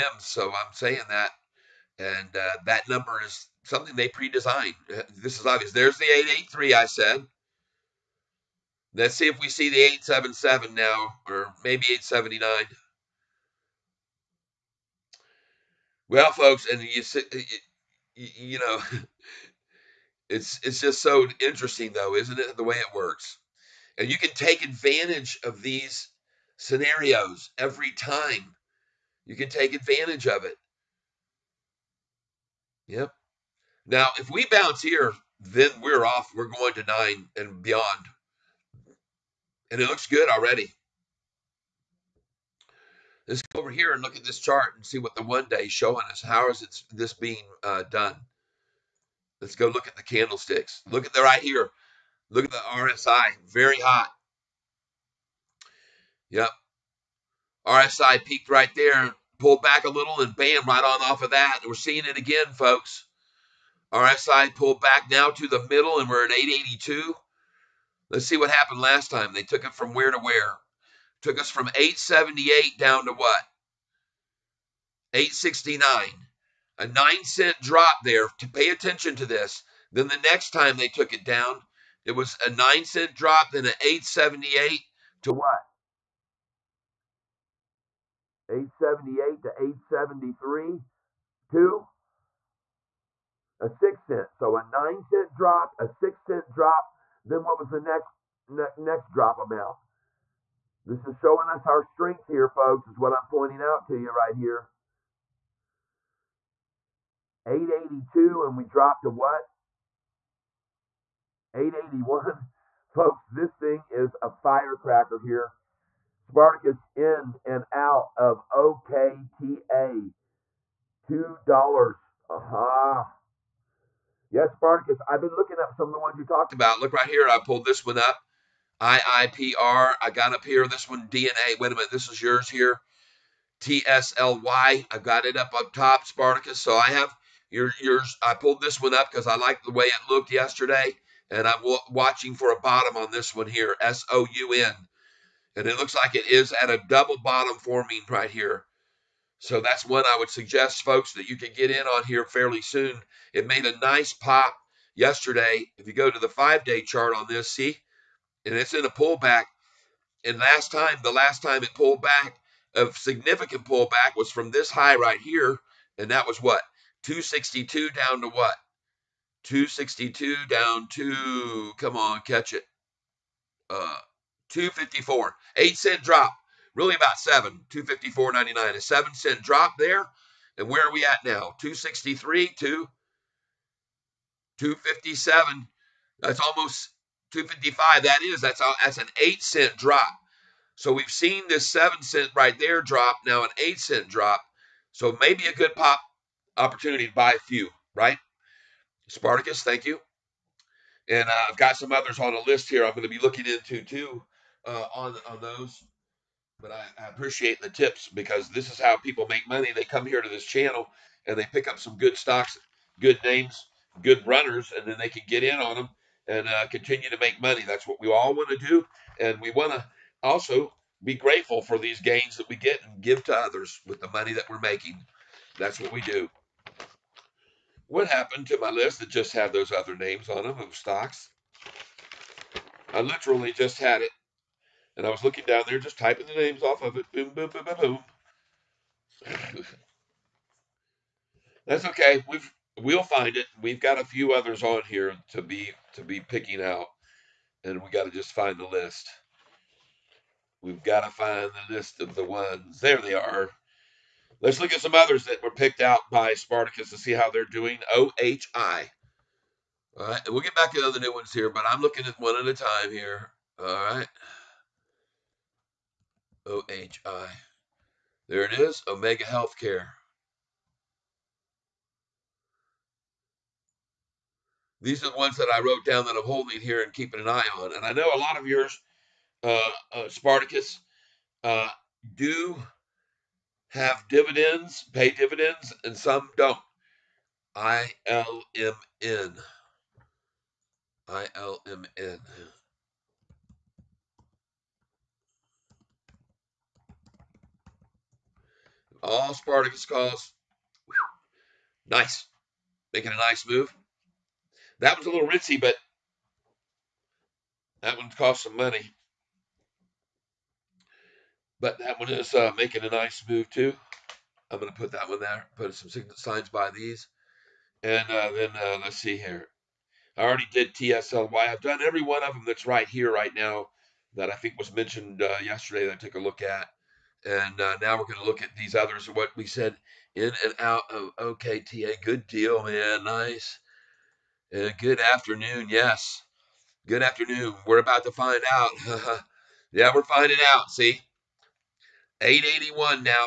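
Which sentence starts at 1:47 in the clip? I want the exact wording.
882, and we dropped to what?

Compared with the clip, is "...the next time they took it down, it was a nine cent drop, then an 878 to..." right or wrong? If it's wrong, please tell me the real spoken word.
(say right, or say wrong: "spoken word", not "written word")
right.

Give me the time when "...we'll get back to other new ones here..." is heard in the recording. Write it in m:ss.
4:20.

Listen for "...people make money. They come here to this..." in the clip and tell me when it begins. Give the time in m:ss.
3:28.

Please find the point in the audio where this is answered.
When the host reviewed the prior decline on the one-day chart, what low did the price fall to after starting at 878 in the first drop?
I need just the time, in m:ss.
1:15.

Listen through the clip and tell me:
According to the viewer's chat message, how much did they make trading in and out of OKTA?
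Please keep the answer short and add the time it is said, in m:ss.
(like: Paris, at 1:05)
$2, at 2:01.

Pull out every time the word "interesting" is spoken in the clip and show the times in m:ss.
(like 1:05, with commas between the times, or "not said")
0:21.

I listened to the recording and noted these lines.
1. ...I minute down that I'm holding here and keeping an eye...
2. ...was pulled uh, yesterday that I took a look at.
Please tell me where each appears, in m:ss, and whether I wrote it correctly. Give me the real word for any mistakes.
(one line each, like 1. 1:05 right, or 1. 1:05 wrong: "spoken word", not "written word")
1. 4:35 wrong: "wrote", not "minute"
2. 5:24 wrong: "mentioned", not "pulled".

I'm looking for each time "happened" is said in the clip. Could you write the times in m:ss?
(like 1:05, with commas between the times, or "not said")
1:08, 3:48.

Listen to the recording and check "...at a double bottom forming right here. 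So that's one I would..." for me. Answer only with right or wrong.
right.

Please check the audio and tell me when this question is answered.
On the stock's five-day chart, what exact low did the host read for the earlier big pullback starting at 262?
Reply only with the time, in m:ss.
2:57.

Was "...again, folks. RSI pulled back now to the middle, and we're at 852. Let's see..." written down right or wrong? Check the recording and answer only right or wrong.
wrong.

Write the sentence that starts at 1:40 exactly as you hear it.
This is showing us our strength here, folks, is what I'm pointing out to you right here.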